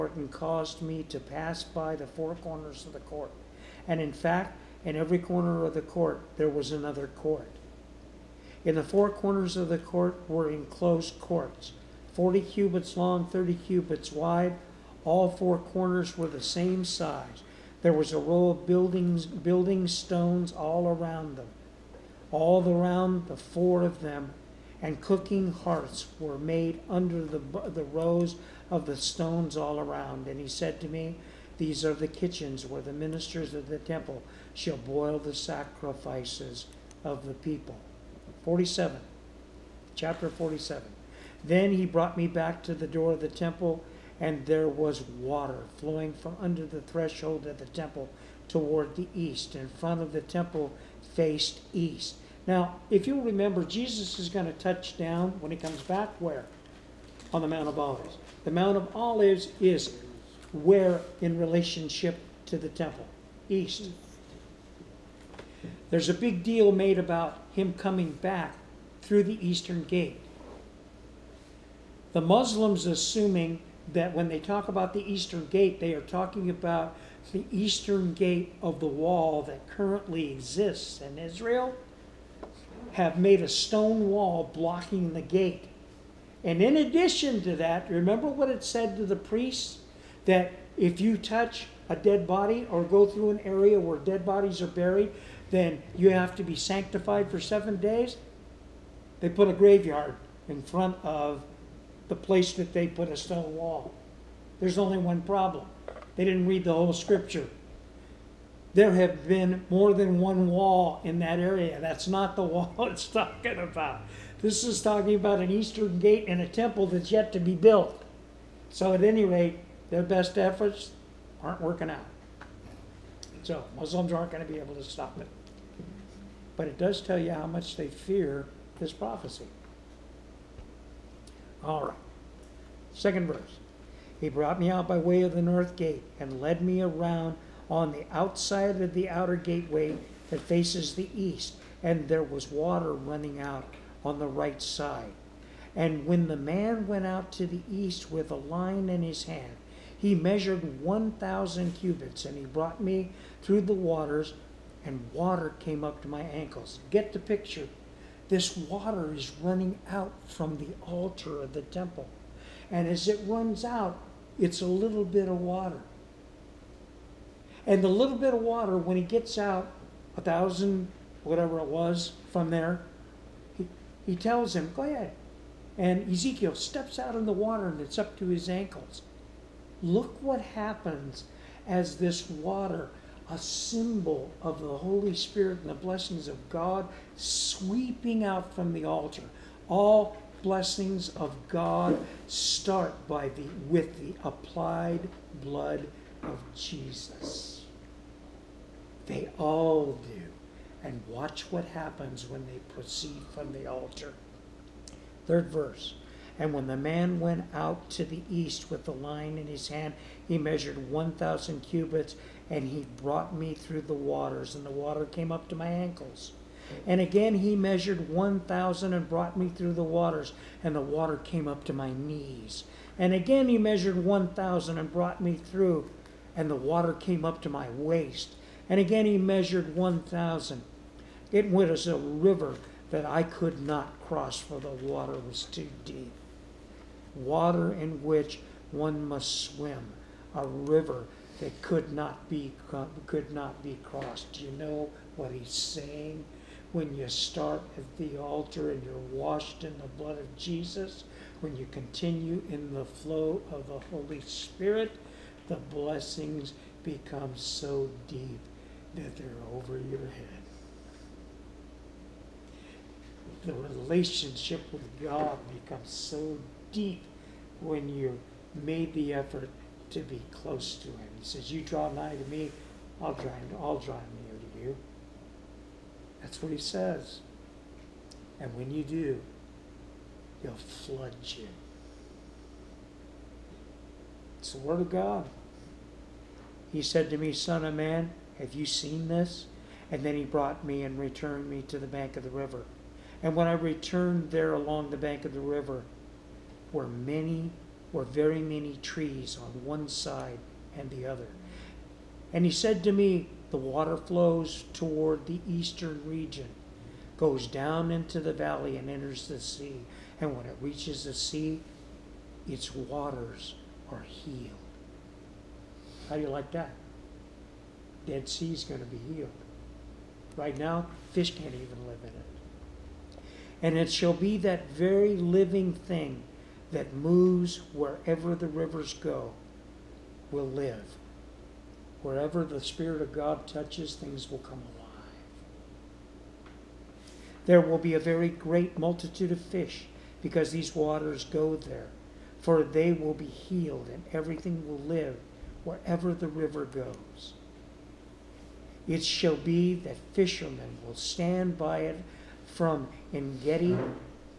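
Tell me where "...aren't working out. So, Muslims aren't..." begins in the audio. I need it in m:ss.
2:01.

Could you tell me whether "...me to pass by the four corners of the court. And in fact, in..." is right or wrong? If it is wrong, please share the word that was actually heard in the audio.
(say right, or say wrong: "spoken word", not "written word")
right.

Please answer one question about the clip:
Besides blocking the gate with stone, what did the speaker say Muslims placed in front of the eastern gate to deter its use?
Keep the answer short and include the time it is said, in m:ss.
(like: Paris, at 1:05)
A graveyard, at 1:39.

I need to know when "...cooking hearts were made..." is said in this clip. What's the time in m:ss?
0:24.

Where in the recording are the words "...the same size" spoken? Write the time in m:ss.
0:16.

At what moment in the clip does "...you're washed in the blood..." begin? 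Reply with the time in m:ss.
4:08.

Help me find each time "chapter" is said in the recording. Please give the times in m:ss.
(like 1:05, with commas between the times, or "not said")
0:39.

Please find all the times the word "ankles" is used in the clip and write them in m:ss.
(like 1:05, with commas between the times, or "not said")
2:36, 2:58, 3:35.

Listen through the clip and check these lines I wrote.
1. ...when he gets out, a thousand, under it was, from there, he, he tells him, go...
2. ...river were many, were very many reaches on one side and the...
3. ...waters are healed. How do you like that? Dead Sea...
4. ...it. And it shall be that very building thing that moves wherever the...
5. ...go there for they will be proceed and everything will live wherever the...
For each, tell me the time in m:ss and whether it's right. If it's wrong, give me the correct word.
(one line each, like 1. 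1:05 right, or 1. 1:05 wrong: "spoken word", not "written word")
1. 2:48 wrong: "whatever", not "under"
2. 4:55 wrong: "trees", not "reaches"
3. 5:12 right
4. 5:22 wrong: "living", not "building"
5. 5:41 wrong: "healed", not "proceed".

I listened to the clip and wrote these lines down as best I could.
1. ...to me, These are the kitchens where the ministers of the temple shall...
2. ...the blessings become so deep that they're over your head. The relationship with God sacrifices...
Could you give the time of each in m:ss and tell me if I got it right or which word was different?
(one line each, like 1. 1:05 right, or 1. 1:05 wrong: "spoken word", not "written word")
1. 0:30 right
2. 4:15 wrong: "becomes", not "sacrifices".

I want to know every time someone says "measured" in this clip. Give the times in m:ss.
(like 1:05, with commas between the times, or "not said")
2:30, 3:30, 3:37, 3:43, 3:49.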